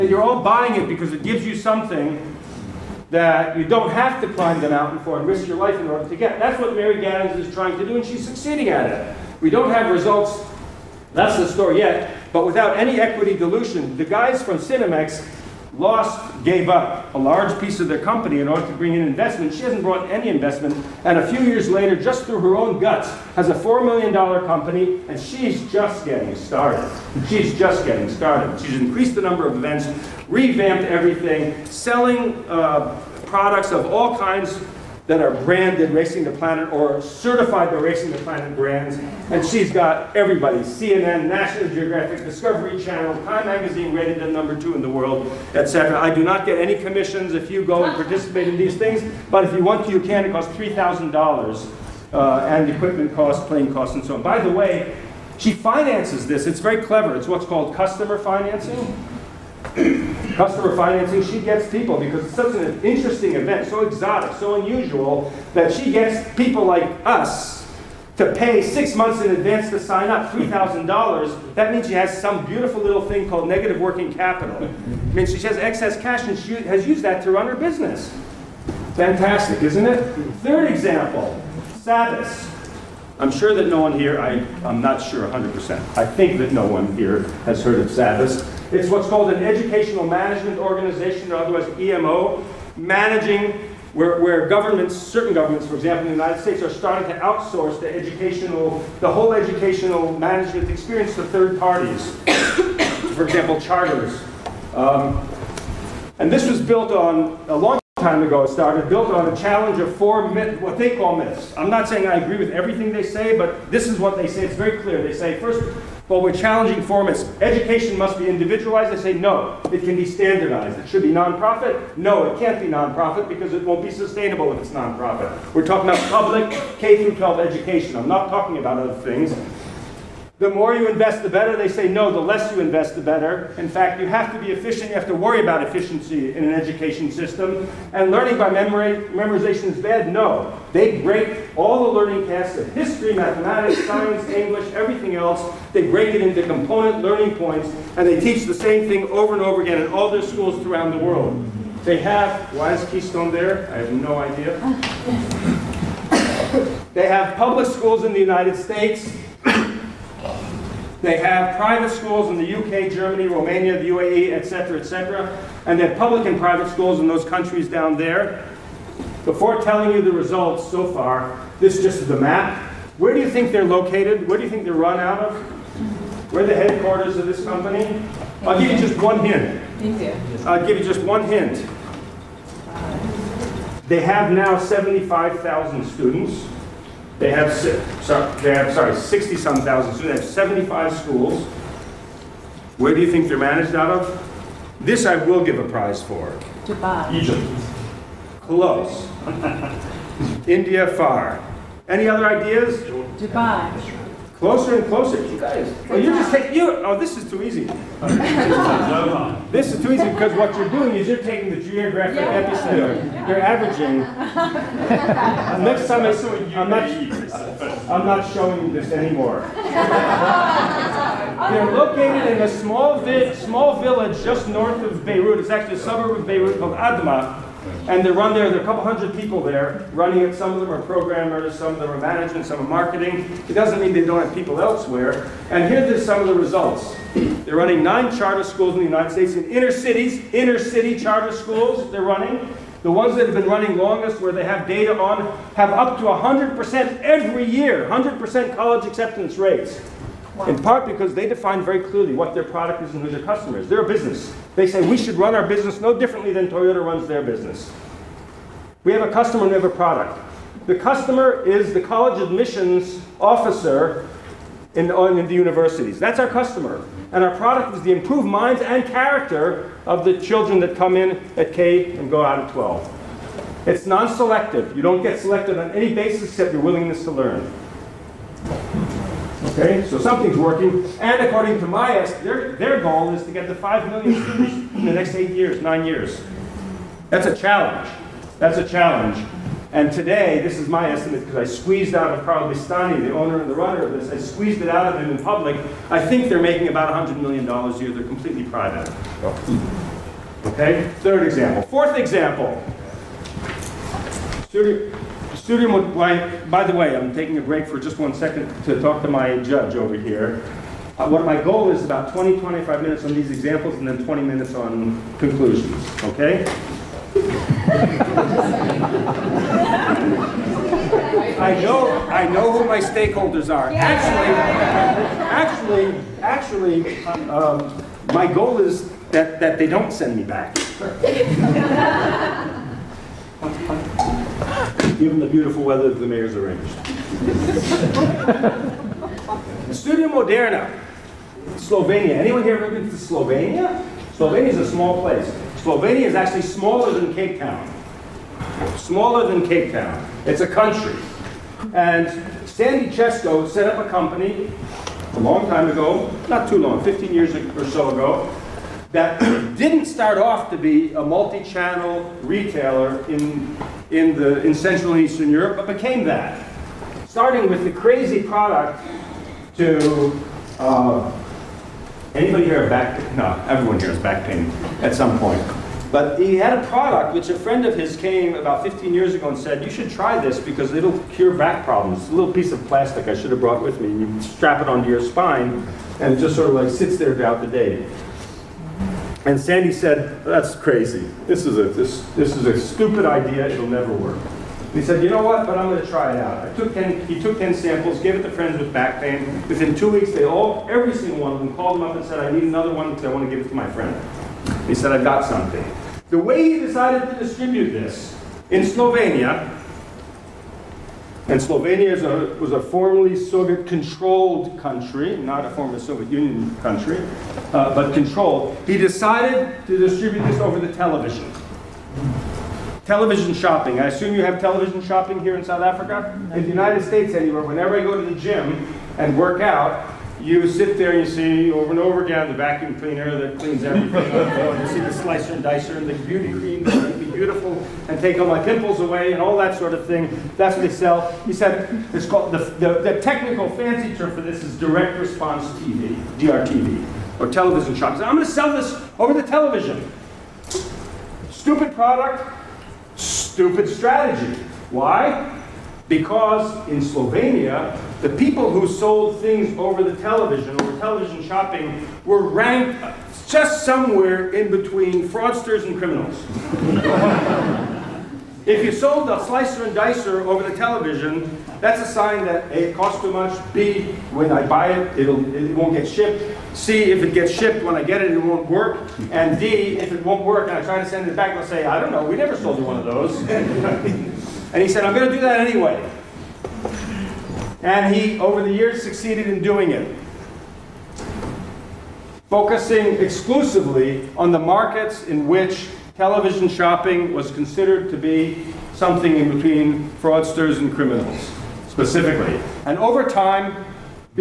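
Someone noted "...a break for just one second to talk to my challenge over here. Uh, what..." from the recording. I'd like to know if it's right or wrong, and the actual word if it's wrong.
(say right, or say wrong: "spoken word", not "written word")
wrong: "judge", not "challenge".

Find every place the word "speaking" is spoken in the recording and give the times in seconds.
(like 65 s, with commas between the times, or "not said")
not said.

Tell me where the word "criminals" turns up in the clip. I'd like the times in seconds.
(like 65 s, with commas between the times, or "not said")
465 s, 500 s.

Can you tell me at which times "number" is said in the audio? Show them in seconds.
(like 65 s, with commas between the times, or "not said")
29 s, 44 s.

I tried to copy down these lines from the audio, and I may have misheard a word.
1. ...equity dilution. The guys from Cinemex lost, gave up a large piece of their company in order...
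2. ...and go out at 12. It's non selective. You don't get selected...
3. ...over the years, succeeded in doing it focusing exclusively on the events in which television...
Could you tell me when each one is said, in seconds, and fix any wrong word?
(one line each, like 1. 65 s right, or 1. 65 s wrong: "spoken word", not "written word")
1. 13 s right
2. 271 s right
3. 488 s wrong: "markets", not "events".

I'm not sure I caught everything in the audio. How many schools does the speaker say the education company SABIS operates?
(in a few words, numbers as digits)
75.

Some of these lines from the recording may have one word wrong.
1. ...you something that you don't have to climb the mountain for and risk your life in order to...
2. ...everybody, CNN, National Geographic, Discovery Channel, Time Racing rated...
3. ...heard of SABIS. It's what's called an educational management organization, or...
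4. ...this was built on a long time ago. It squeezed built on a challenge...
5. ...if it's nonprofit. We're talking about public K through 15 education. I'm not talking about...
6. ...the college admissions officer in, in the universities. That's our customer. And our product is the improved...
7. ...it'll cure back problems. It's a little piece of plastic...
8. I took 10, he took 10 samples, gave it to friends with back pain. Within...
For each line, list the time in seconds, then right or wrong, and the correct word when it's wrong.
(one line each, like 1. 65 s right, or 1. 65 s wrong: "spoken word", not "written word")
1. 1 s right
2. 40 s wrong: "Magazine", not "Racing"
3. 87 s right
4. 106 s wrong: "started", not "squeezed"
5. 124 s wrong: "12", not "15"
6. 261 s right
7. 380 s right
8. 396 s right.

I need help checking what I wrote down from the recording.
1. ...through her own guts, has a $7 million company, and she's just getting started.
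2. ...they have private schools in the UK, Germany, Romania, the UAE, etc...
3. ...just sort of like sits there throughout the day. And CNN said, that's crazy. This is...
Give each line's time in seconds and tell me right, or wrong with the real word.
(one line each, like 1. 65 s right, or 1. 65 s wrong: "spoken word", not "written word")
1. 22 s wrong: "4", not "7"
2. 161 s right
3. 386 s wrong: "Sandi", not "CNN".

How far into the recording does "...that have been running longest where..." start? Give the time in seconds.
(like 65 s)
243 s.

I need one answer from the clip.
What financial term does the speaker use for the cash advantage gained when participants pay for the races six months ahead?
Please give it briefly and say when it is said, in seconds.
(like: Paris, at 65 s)
negative working capital, at 73 s.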